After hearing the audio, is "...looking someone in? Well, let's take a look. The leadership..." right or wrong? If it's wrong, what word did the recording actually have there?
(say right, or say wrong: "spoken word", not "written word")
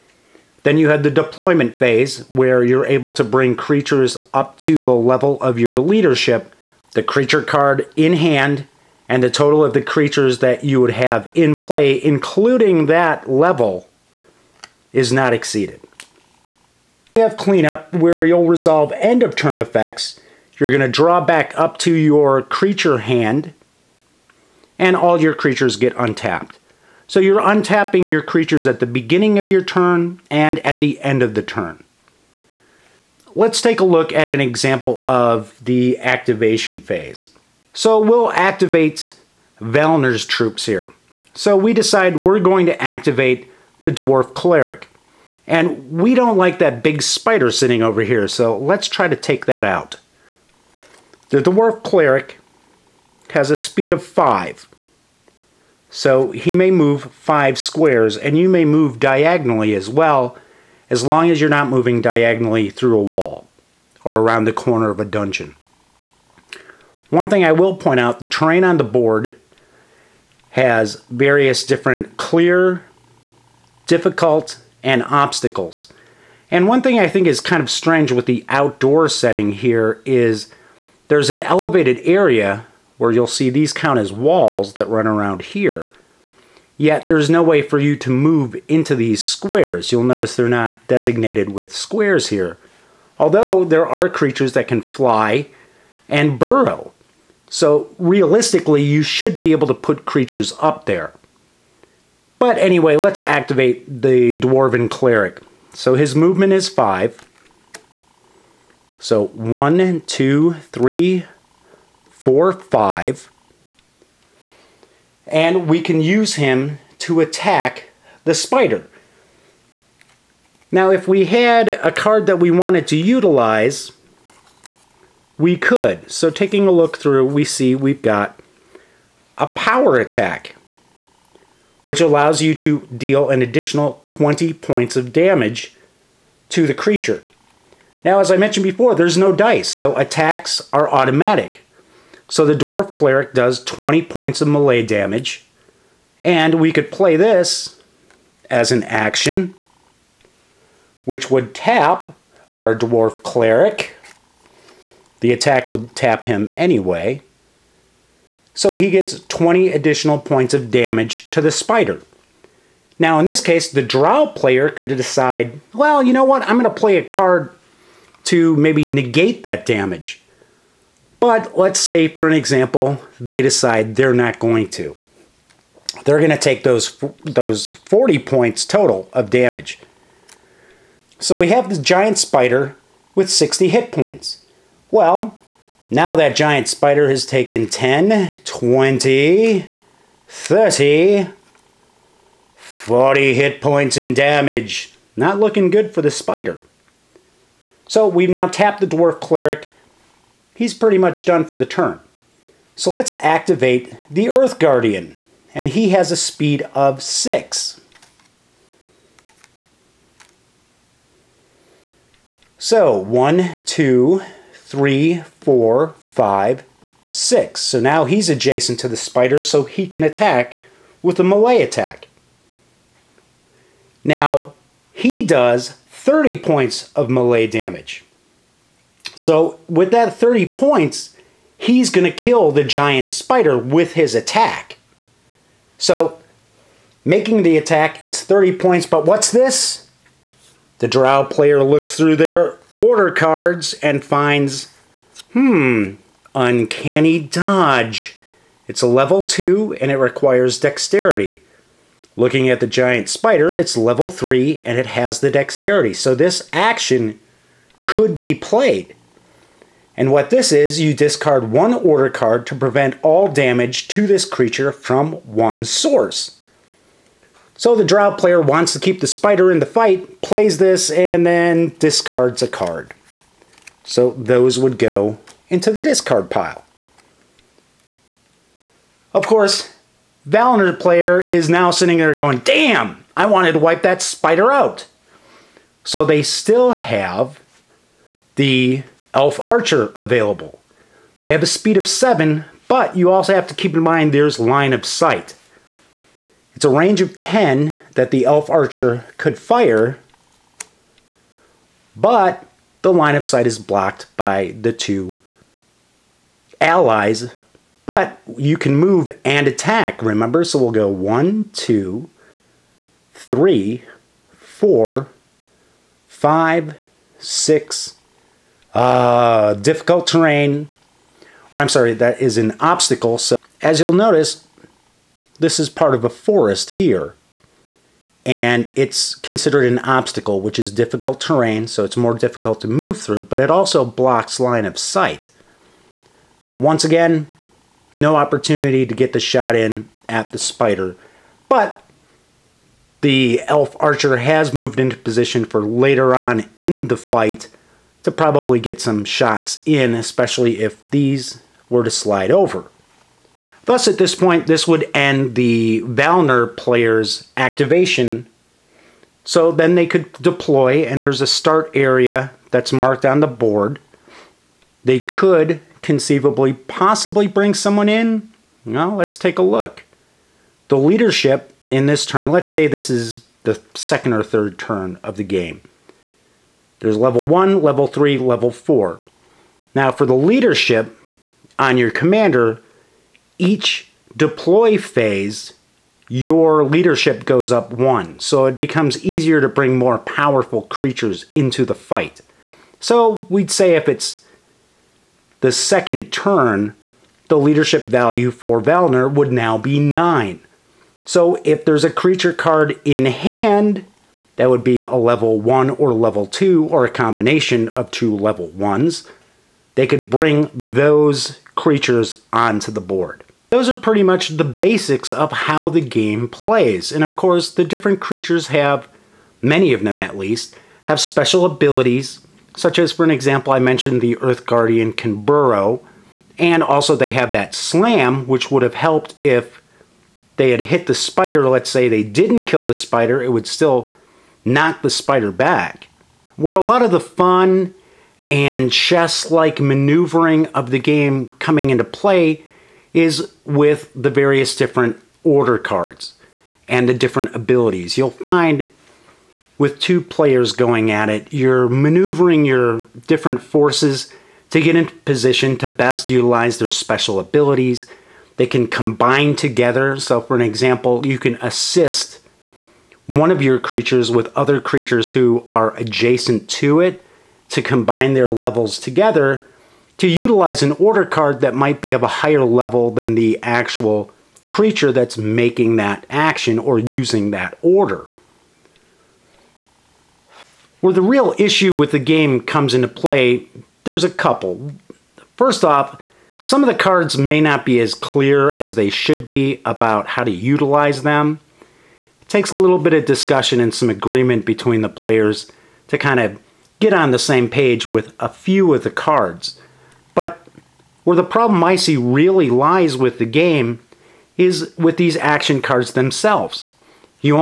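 wrong: "bring", not "looking".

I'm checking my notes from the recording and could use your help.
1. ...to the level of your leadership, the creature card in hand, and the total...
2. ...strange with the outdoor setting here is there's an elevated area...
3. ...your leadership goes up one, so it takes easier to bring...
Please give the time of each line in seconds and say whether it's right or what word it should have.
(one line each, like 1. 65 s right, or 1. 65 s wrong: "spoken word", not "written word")
1. 4 s right
2. 77 s right
3. 386 s wrong: "becomes", not "takes".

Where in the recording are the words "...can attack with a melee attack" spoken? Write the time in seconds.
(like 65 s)
219 s.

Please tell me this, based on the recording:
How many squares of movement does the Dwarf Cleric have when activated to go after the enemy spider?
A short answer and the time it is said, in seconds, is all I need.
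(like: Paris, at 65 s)
5, at 53 s.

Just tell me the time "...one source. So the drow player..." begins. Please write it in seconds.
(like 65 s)
265 s.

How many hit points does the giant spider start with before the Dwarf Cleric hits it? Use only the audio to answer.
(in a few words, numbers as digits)
60.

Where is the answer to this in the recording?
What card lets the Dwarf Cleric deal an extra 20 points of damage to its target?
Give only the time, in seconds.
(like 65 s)
129 s.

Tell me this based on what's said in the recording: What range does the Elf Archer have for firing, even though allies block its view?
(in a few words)
10.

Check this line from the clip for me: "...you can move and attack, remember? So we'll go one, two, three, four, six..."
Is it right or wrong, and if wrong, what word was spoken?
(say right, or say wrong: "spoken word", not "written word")
wrong: "five", not "six".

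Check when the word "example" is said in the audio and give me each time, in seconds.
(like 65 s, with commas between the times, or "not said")
34 s, 172 s, 423 s, 460 s.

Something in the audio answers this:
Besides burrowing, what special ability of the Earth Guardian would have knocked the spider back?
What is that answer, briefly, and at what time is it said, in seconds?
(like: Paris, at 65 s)
Slam, at 427 s.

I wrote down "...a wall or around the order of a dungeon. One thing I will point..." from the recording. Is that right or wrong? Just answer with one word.
wrong.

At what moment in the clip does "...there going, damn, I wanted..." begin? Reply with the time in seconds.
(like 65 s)
281 s.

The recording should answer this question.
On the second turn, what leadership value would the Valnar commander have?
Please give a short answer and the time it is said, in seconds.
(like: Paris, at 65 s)
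9, at 399 s.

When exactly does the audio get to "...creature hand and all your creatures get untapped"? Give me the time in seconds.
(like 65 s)
22 s.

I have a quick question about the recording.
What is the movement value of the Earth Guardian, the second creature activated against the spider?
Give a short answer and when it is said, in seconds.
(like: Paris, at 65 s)
6, at 206 s.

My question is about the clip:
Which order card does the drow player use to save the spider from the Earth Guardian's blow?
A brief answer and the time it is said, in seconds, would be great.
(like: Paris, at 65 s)
Uncanny Dodge, at 246 s.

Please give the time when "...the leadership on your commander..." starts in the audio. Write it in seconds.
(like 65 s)
380 s.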